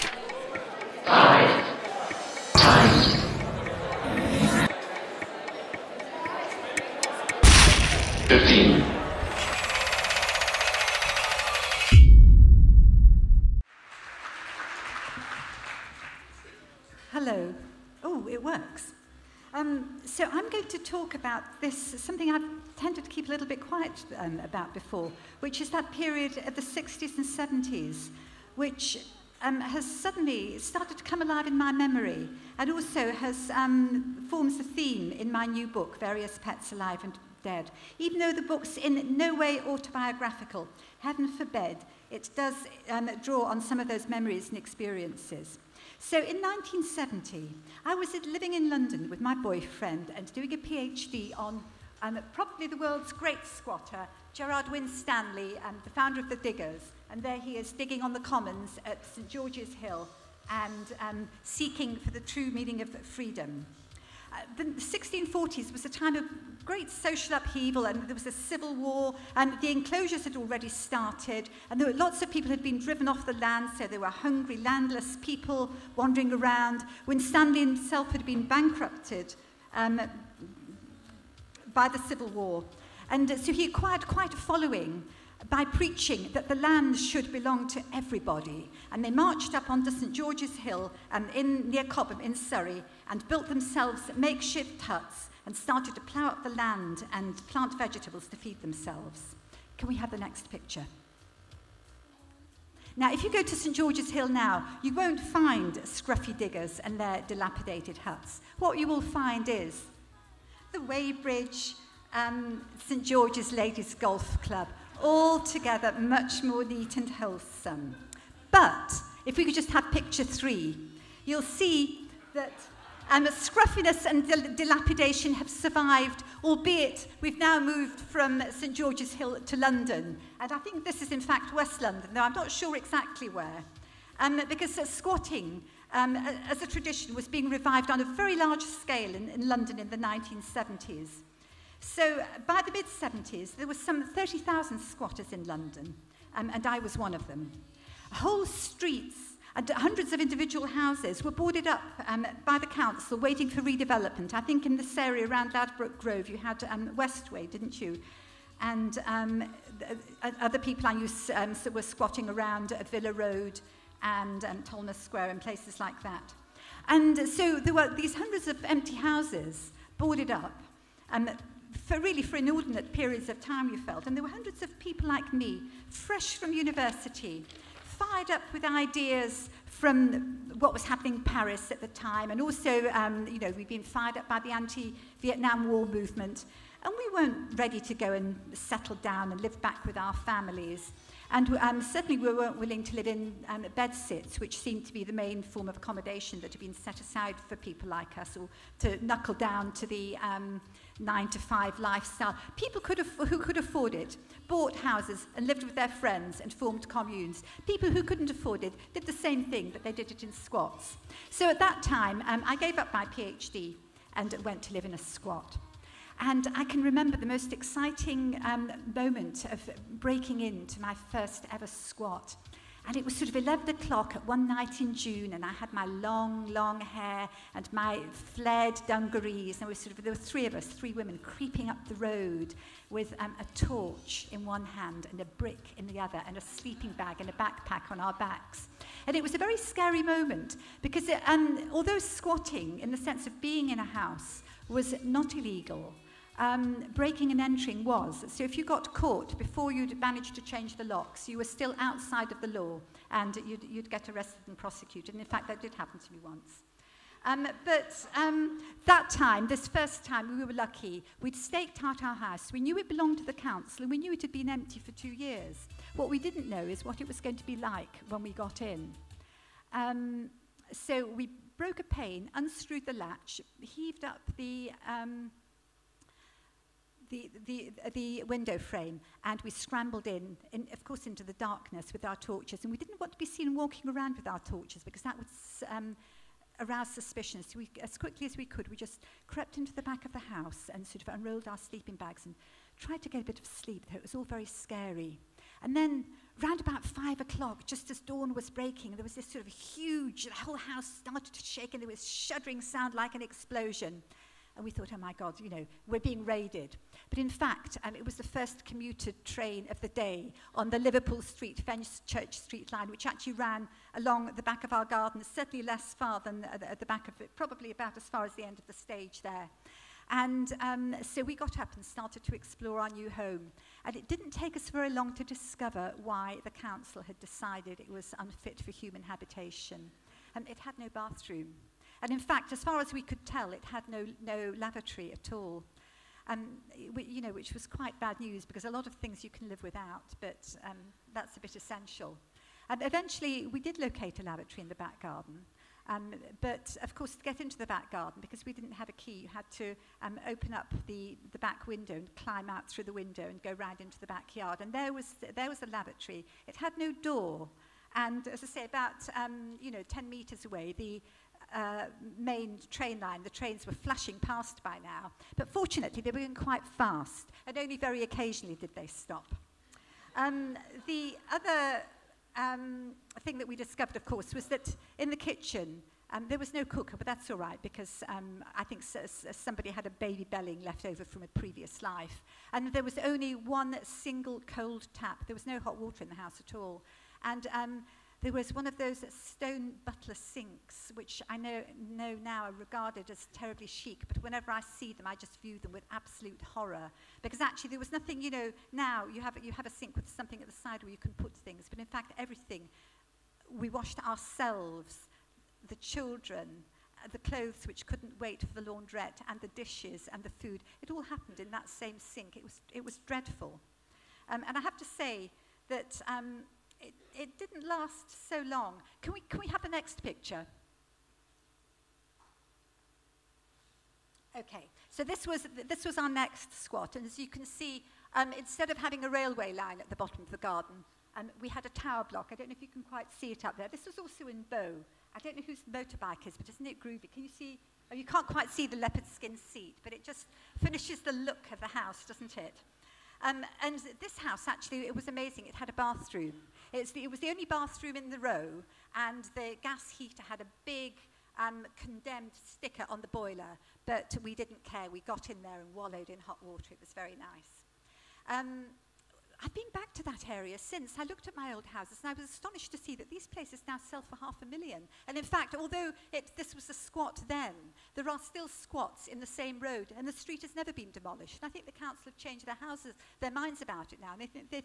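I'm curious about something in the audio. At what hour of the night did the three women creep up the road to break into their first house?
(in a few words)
11 o'clock.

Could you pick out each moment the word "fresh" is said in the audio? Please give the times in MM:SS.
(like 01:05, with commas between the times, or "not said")
02:55.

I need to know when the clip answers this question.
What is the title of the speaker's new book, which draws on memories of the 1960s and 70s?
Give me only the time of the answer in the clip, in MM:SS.
00:35.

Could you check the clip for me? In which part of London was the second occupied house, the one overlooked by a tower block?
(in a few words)
Bow.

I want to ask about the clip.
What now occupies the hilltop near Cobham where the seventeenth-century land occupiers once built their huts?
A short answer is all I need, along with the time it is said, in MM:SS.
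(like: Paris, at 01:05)
St George's Ladies Golf Club, at 01:52.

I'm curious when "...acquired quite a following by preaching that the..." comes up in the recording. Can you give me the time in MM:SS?
01:23.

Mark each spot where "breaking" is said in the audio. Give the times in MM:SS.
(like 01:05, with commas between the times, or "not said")
03:39, 04:06, 04:58.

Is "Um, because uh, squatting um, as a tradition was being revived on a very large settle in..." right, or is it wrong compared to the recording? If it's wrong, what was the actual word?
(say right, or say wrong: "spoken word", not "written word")
wrong: "scale", not "settle".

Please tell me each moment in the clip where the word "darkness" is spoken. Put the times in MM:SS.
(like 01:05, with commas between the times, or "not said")
04:41.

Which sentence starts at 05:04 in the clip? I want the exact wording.
And we thought, oh my God, you know, we're being raided.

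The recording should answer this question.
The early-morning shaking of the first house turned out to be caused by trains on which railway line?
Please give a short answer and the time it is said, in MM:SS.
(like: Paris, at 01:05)
Liverpool Street, Fenchurch Street line, at 05:10.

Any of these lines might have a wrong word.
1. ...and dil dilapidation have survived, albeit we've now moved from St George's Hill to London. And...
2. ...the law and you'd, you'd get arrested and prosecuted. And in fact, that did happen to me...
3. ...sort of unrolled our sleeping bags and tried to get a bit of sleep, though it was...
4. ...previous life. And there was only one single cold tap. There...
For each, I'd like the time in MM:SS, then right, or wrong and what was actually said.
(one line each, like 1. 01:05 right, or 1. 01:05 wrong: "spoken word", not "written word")
1. 02:04 right
2. 04:12 right
3. 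04:50 right
4. 06:21 right.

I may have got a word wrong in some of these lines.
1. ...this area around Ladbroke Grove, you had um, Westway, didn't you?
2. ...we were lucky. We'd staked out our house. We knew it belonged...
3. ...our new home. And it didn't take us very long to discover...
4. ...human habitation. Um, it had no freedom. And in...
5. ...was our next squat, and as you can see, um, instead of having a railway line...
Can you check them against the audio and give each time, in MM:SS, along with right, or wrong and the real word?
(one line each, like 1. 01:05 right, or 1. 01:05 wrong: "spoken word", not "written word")
1. 02:34 right
2. 04:20 right
3. 05:22 right
4. 05:28 wrong: "bathroom", not "freedom"
5. 07:05 right.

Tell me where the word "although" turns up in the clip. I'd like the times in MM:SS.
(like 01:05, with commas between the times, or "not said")
04:01, 07:45.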